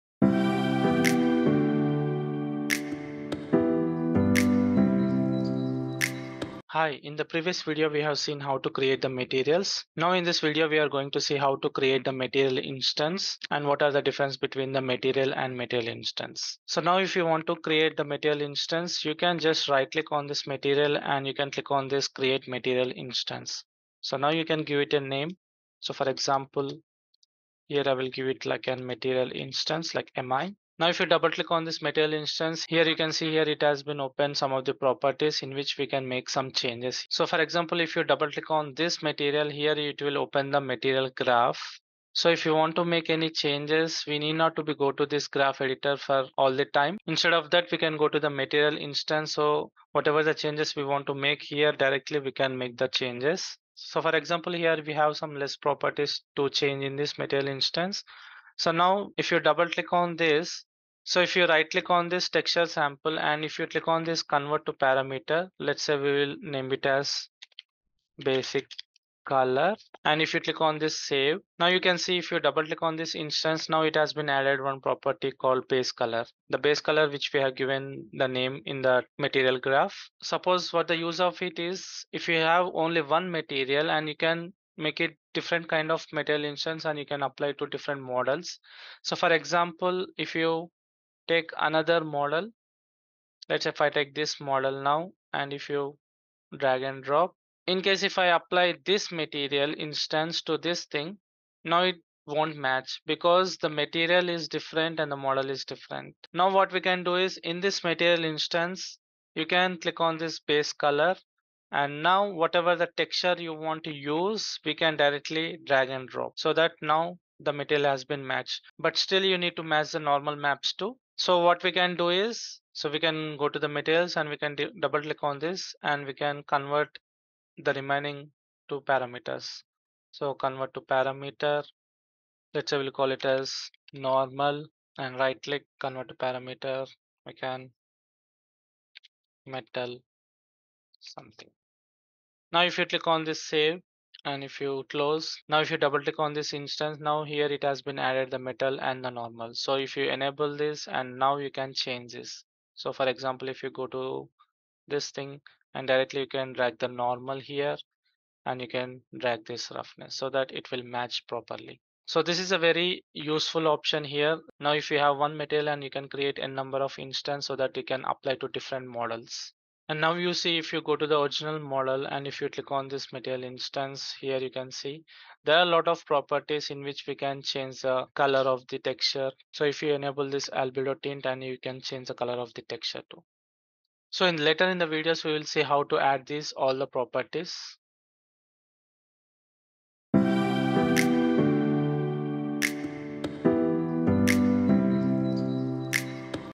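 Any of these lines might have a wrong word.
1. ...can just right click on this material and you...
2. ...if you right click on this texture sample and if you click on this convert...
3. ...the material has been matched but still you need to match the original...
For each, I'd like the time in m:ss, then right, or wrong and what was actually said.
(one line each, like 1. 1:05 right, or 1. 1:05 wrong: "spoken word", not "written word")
1. 0:19 right
2. 1:01 right
3. 1:57 wrong: "normal", not "original".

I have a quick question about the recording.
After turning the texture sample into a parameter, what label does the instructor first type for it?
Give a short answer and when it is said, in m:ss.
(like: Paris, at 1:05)
basic color, at 1:08.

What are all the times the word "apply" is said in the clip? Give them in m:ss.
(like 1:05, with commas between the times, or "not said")
1:27, 1:38, 2:48.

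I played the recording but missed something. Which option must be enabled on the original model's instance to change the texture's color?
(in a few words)
albedo tint.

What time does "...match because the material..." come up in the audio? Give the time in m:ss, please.
1:42.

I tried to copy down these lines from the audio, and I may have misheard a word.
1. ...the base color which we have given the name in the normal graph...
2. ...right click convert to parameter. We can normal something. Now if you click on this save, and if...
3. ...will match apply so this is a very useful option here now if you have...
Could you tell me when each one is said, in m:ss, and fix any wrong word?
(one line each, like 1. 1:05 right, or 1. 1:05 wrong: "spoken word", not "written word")
1. 1:16 wrong: "material", not "normal"
2. 2:15 wrong: "metal", not "normal"
3. 2:40 wrong: "properly", not "apply".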